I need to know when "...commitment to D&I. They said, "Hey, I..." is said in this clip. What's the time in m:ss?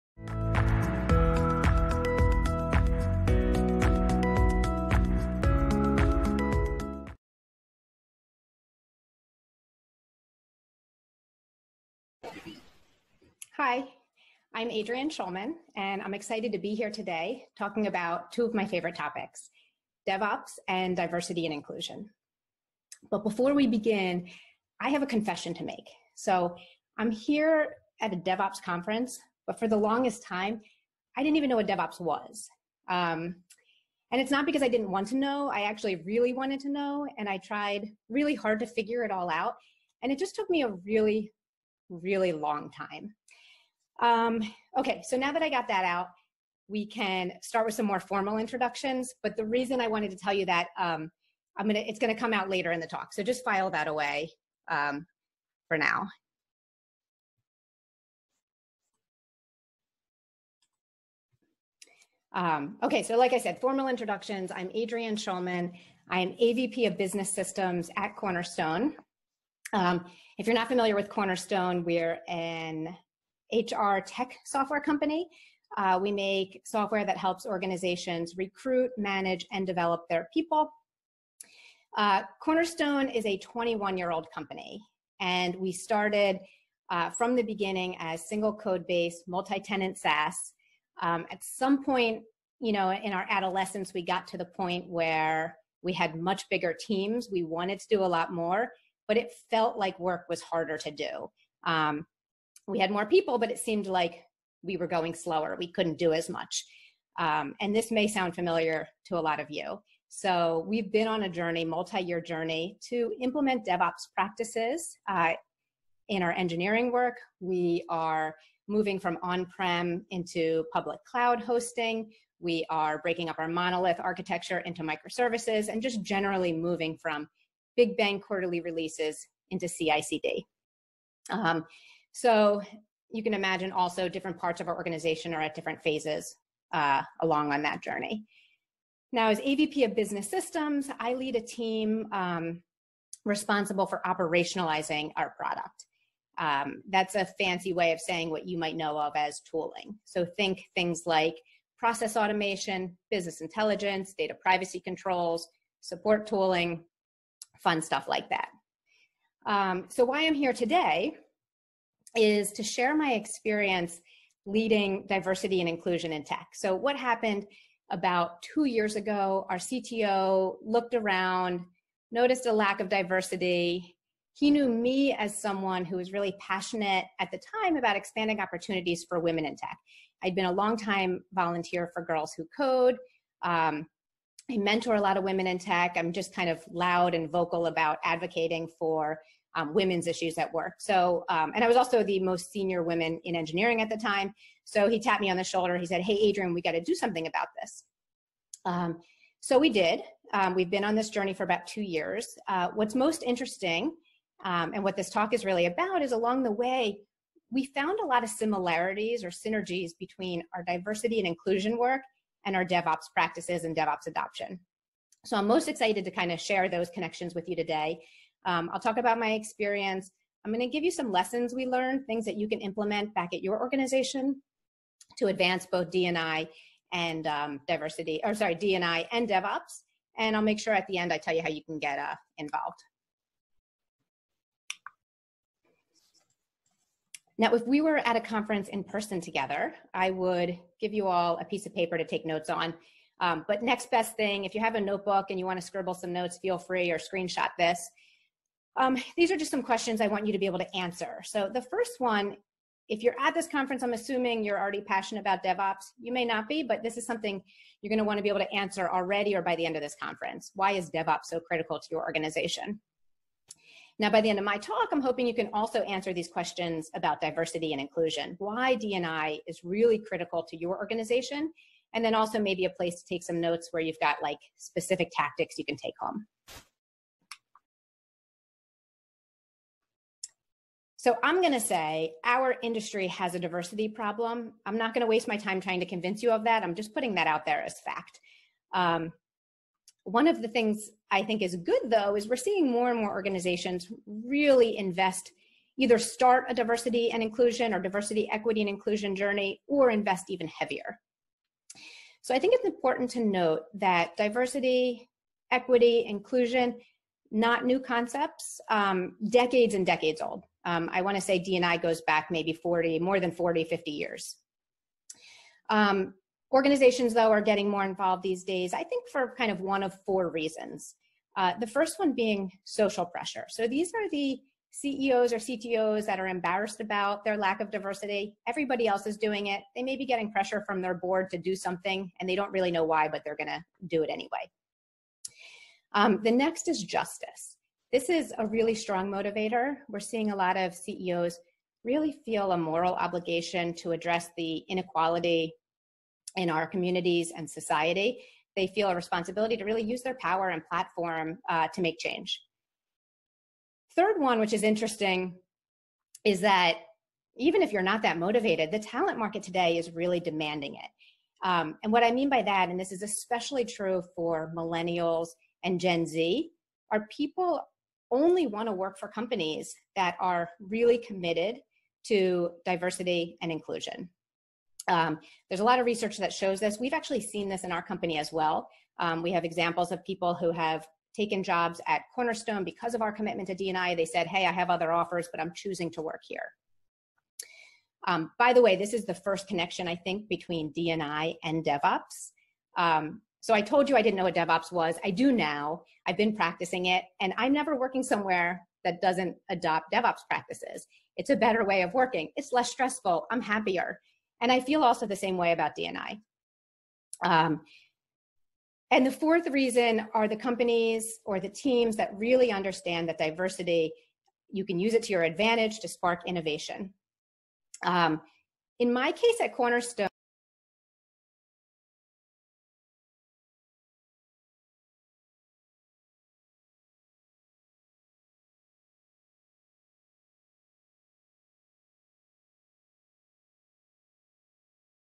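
6:23.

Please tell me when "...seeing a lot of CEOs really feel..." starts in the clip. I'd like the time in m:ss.
5:40.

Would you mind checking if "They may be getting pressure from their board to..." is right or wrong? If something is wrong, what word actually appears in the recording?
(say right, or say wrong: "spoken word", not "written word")
right.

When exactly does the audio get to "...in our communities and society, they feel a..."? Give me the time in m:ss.
5:46.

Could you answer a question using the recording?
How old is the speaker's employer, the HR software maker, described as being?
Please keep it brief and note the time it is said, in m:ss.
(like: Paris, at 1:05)
21 years, at 1:23.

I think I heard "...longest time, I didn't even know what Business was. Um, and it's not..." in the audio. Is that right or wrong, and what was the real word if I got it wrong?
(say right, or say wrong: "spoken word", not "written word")
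wrong: "DevOps", not "Business".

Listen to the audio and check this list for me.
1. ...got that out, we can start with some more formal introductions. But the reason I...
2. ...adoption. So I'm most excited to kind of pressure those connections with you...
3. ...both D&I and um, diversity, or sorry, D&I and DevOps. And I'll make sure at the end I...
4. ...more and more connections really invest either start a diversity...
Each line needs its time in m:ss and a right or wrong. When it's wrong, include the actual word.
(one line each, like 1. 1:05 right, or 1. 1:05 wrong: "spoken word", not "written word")
1. 0:45 right
2. 3:34 wrong: "share", not "pressure"
3. 3:45 right
4. 4:52 wrong: "organizations", not "connections".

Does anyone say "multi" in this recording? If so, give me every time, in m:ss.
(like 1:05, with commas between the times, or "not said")
1:29, 1:51.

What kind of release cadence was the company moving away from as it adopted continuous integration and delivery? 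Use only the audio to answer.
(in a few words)
Big Bang quarterly releases.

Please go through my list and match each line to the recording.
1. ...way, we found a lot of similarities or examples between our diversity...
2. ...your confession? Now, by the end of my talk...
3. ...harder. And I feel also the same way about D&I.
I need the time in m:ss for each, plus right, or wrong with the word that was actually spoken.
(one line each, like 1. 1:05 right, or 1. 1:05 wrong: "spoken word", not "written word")
1. 3:26 wrong: "synergies", not "examples"
2. 4:21 wrong: "organization", not "confession"
3. 6:43 wrong: "happier", not "harder".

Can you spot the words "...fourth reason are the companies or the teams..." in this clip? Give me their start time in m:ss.
6:49.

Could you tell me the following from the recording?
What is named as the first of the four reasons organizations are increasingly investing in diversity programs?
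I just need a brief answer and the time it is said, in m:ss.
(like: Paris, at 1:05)
Social pressure, at 5:22.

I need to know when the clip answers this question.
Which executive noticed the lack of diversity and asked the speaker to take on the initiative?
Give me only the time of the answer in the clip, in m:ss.
2:49.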